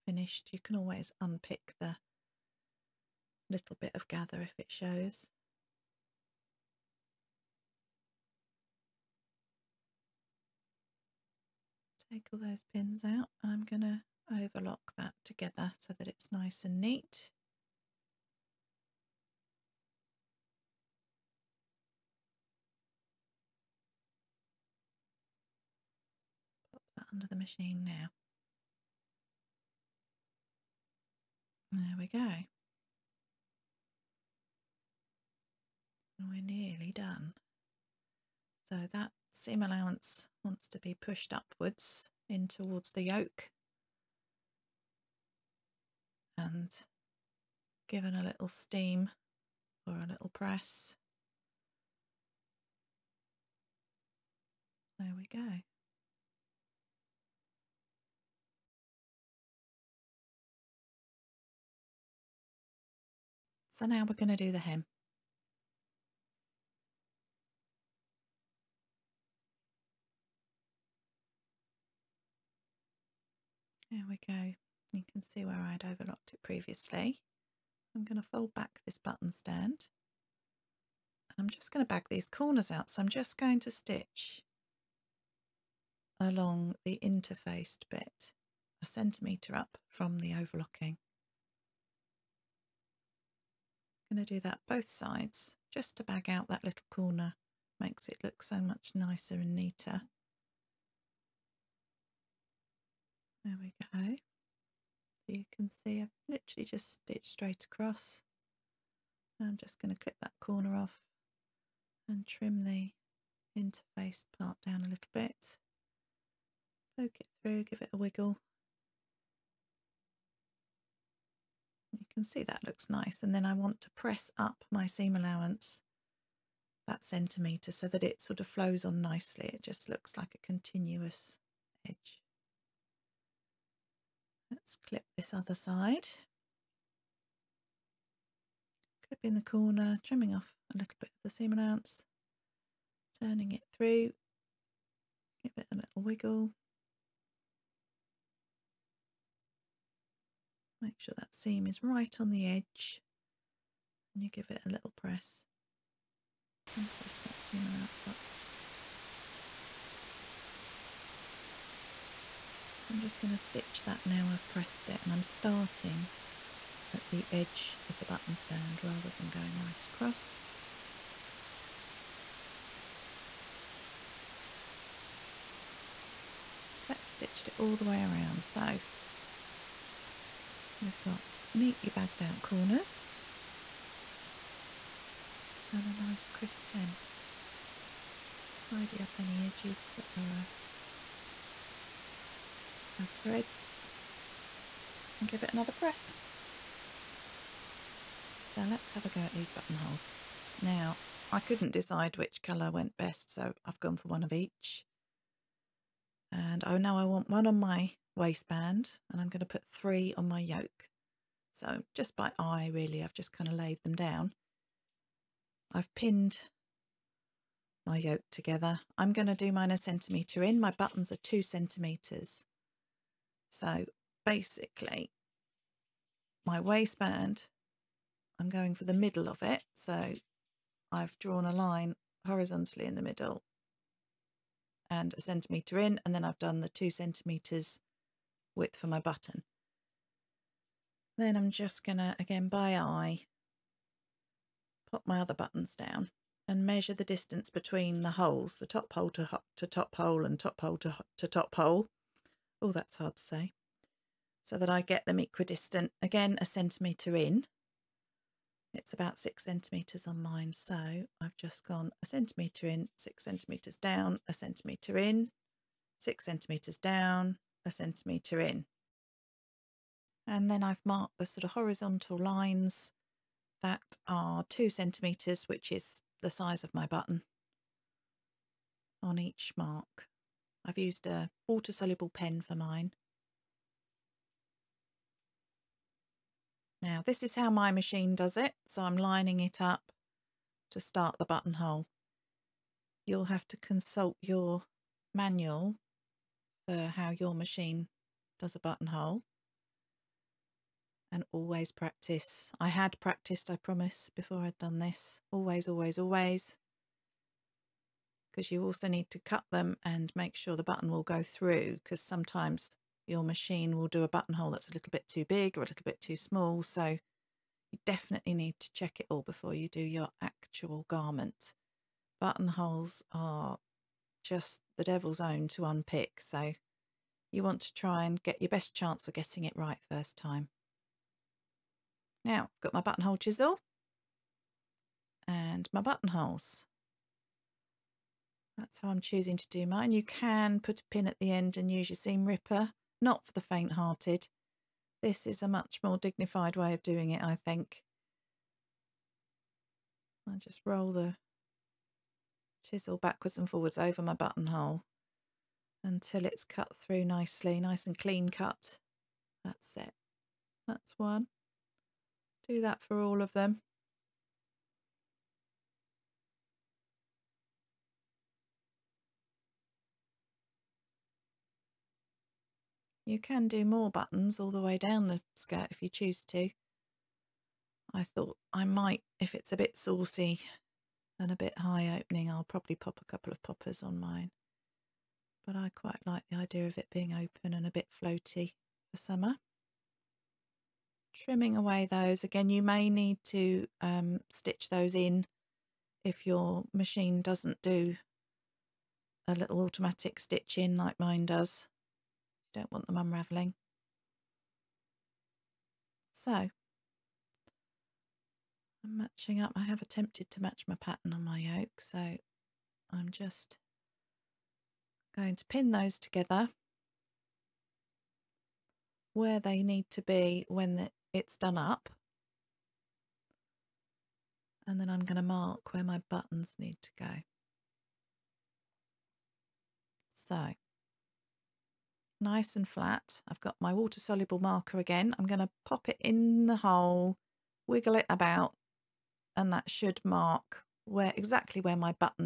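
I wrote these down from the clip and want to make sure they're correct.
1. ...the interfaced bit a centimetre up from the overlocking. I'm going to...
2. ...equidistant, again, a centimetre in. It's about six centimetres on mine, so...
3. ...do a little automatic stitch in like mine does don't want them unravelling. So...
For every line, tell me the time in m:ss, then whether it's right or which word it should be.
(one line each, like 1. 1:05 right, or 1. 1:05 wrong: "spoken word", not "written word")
1. 1:26 right
2. 4:15 right
3. 6:37 right.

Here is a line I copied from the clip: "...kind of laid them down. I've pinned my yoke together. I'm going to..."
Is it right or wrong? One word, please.
right.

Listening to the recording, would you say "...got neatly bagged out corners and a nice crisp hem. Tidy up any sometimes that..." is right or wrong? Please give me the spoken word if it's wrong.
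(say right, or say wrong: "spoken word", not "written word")
wrong: "edges", not "sometimes".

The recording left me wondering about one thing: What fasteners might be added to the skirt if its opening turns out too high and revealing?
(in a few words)
poppers.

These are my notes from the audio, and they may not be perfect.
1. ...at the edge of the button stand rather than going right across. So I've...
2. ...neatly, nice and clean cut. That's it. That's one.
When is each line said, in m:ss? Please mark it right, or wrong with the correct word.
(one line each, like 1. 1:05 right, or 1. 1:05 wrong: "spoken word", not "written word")
1. 2:46 right
2. 5:57 wrong: "nicely", not "neatly".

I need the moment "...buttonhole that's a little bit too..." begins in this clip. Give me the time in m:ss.
5:14.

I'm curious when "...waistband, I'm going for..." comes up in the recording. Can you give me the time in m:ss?
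3:46.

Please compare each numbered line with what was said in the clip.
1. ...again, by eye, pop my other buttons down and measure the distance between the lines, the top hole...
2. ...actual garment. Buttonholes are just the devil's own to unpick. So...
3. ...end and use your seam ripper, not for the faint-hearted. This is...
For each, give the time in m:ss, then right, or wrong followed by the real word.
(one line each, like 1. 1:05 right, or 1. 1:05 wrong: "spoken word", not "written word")
1. 4:02 wrong: "holes", not "lines"
2. 5:20 right
3. 5:41 right.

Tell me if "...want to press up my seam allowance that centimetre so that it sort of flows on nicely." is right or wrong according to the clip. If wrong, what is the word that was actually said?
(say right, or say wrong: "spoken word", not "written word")
right.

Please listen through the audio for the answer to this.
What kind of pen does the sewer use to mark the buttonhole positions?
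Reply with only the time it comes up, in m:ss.
4:41.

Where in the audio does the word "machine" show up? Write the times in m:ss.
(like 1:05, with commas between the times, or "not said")
0:27, 4:47, 4:57, 5:13, 6:36.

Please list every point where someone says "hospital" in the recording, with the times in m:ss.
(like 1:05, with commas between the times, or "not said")
not said.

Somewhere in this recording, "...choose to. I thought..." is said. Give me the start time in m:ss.
6:15.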